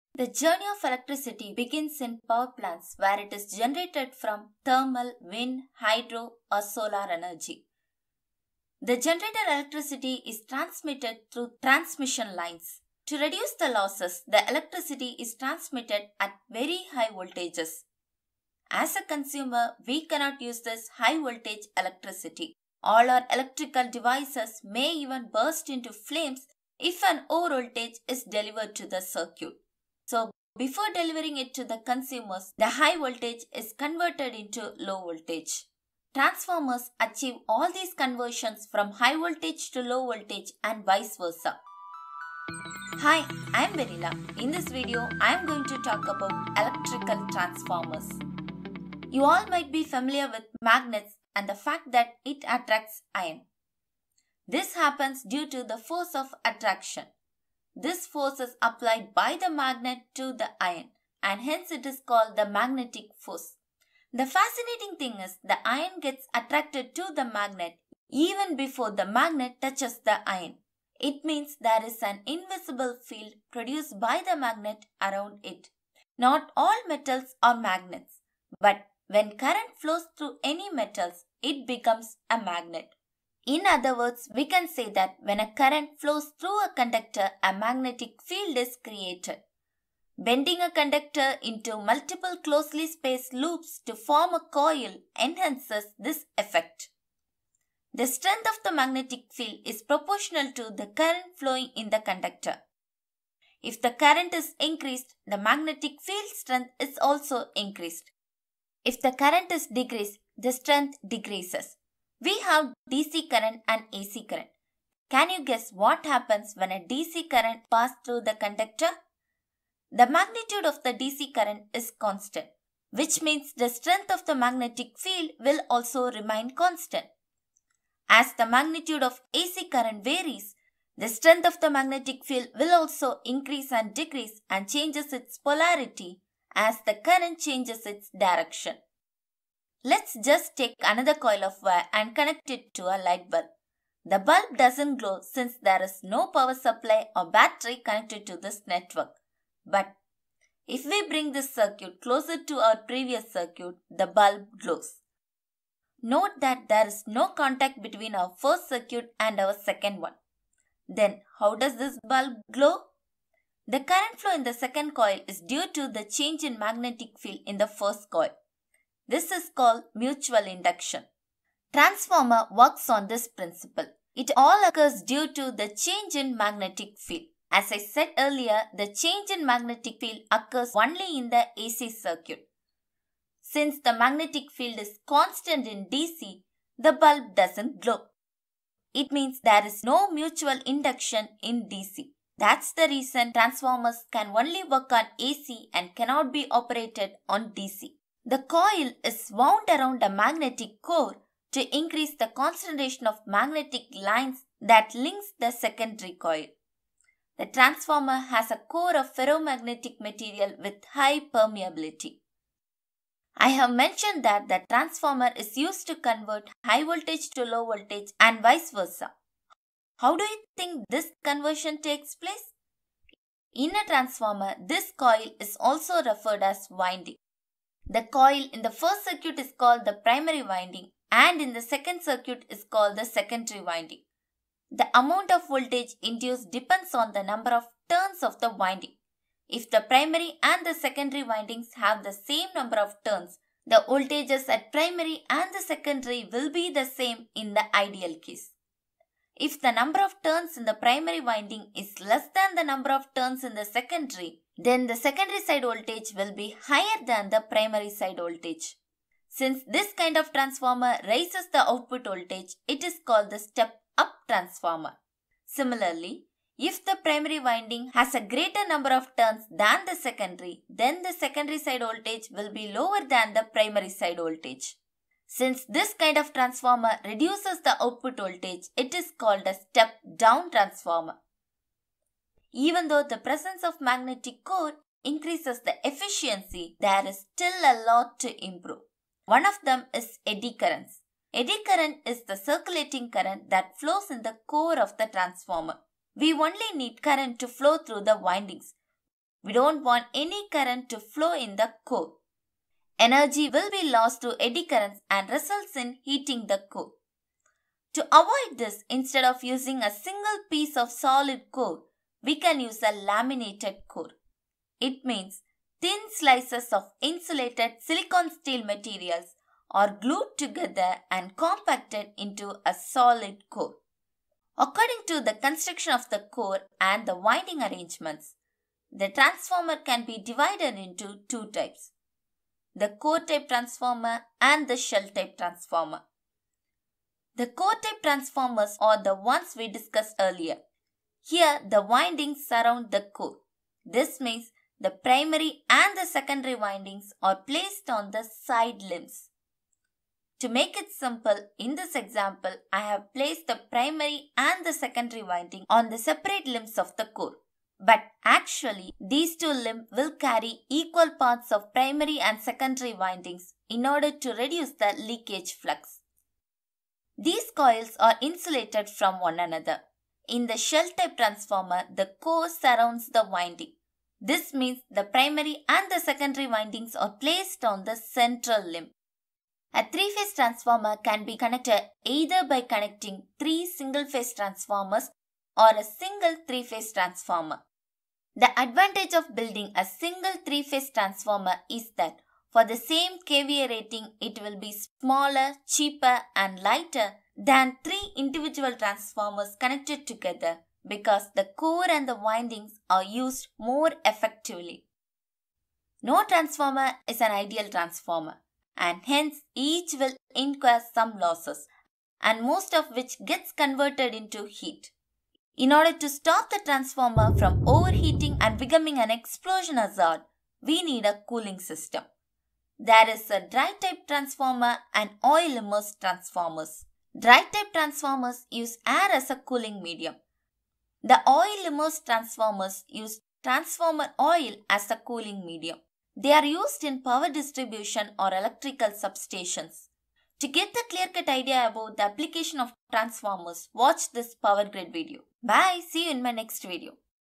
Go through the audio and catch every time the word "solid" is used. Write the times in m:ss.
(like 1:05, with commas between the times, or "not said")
5:10, 5:22.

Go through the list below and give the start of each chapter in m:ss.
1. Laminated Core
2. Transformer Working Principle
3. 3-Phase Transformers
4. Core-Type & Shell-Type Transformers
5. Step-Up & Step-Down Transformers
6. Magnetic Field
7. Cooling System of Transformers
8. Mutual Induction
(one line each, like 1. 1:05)
1. 4:43
2. 2:52
3. 6:20
4. 5:24
5. 3:18
6. 0:48
7. 6:45
8. 2:19.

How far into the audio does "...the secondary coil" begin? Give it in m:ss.
3:25.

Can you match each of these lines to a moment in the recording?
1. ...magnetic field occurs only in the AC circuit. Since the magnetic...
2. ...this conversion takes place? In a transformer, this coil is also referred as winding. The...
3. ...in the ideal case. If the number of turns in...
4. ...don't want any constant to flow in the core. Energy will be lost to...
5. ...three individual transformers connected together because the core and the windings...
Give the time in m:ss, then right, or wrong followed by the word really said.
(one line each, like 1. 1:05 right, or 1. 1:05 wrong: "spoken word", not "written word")
1. 2:59 right
2. 3:40 right
3. 4:07 right
4. 4:59 wrong: "current", not "constant"
5. 6:37 right.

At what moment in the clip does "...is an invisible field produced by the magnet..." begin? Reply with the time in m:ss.
1:11.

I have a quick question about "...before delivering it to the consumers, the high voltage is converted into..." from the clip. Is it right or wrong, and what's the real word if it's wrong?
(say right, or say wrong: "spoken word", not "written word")
right.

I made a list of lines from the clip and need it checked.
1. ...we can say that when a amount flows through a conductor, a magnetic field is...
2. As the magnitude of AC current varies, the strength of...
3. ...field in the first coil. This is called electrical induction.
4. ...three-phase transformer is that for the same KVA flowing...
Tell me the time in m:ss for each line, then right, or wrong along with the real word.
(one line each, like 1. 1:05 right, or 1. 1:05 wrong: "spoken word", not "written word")
1. 1:24 wrong: "current", not "amount"
2. 2:08 right
3. 2:47 wrong: "mutual", not "electrical"
4. 6:30 wrong: "rating", not "flowing".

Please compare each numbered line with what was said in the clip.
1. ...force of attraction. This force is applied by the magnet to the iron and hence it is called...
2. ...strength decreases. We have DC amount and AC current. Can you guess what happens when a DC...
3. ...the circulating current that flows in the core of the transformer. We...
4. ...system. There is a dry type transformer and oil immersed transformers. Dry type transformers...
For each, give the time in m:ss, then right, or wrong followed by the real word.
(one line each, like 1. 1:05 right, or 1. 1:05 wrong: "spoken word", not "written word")
1. 0:55 right
2. 1:50 wrong: "current", not "amount"
3. 4:52 right
4. 7:01 right.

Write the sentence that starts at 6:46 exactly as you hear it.
No transformer is an ideal transformer and hence each will incur some losses and most of which gets converted into heat.